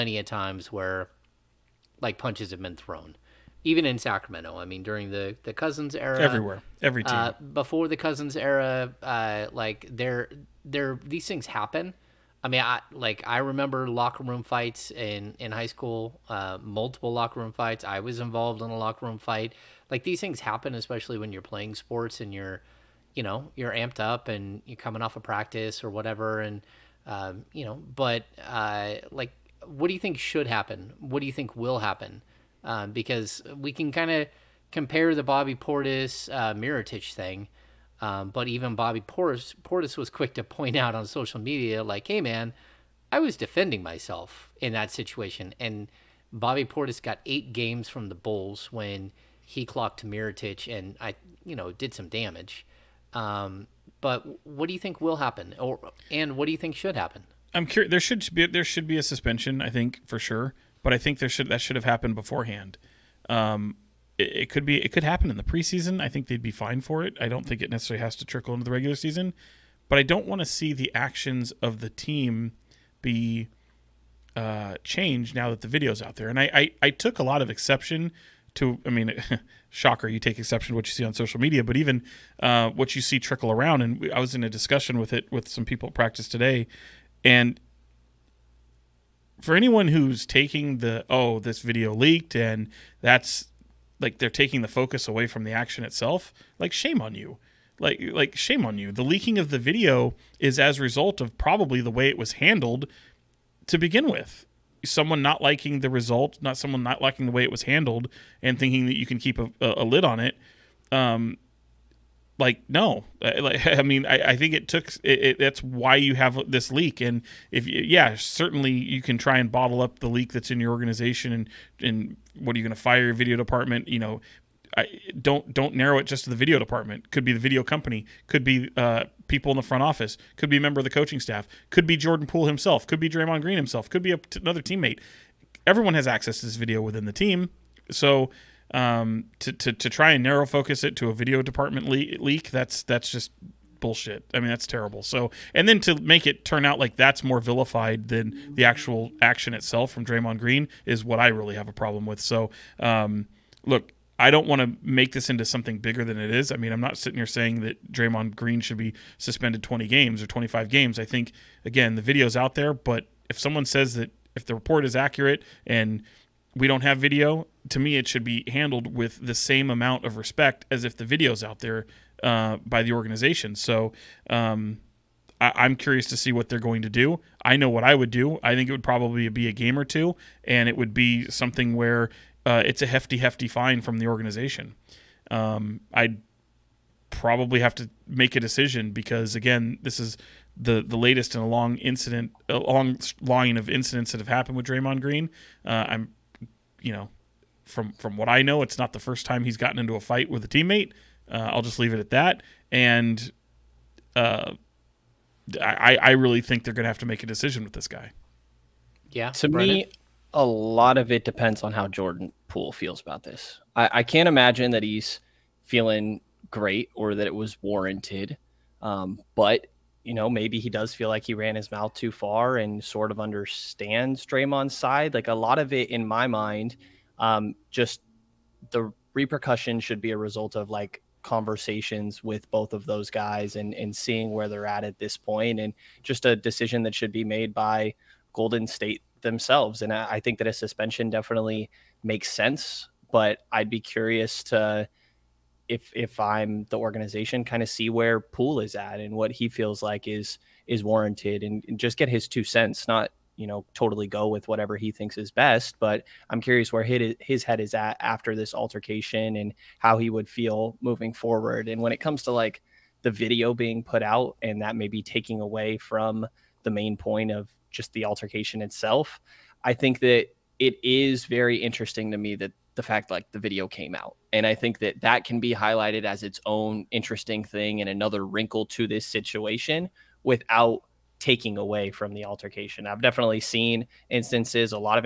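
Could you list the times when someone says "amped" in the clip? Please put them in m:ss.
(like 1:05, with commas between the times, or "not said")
0:23.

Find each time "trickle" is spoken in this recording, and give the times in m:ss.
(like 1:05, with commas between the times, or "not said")
1:08, 1:23.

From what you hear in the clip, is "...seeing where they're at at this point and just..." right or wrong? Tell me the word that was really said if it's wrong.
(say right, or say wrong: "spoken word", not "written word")
right.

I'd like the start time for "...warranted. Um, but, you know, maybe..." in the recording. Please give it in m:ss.
3:37.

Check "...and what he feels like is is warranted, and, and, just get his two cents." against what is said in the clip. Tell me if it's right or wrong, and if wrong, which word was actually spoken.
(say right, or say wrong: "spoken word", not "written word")
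right.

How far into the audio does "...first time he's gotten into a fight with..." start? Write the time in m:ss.
3:18.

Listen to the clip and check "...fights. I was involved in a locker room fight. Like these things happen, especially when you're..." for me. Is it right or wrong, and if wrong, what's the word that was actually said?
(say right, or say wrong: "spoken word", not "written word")
right.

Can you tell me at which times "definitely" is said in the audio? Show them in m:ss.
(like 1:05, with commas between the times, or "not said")
4:01, 4:43.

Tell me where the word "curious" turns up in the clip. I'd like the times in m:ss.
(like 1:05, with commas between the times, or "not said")
0:57, 2:55, 4:03, 4:16.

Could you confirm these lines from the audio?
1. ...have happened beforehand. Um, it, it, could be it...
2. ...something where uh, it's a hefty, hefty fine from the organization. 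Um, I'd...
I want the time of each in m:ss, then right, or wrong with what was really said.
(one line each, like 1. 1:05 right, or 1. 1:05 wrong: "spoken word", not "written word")
1. 1:01 right
2. 3:01 right.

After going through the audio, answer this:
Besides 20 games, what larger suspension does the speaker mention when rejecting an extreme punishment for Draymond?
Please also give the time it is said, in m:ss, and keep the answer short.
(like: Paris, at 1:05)
25 games, at 2:40.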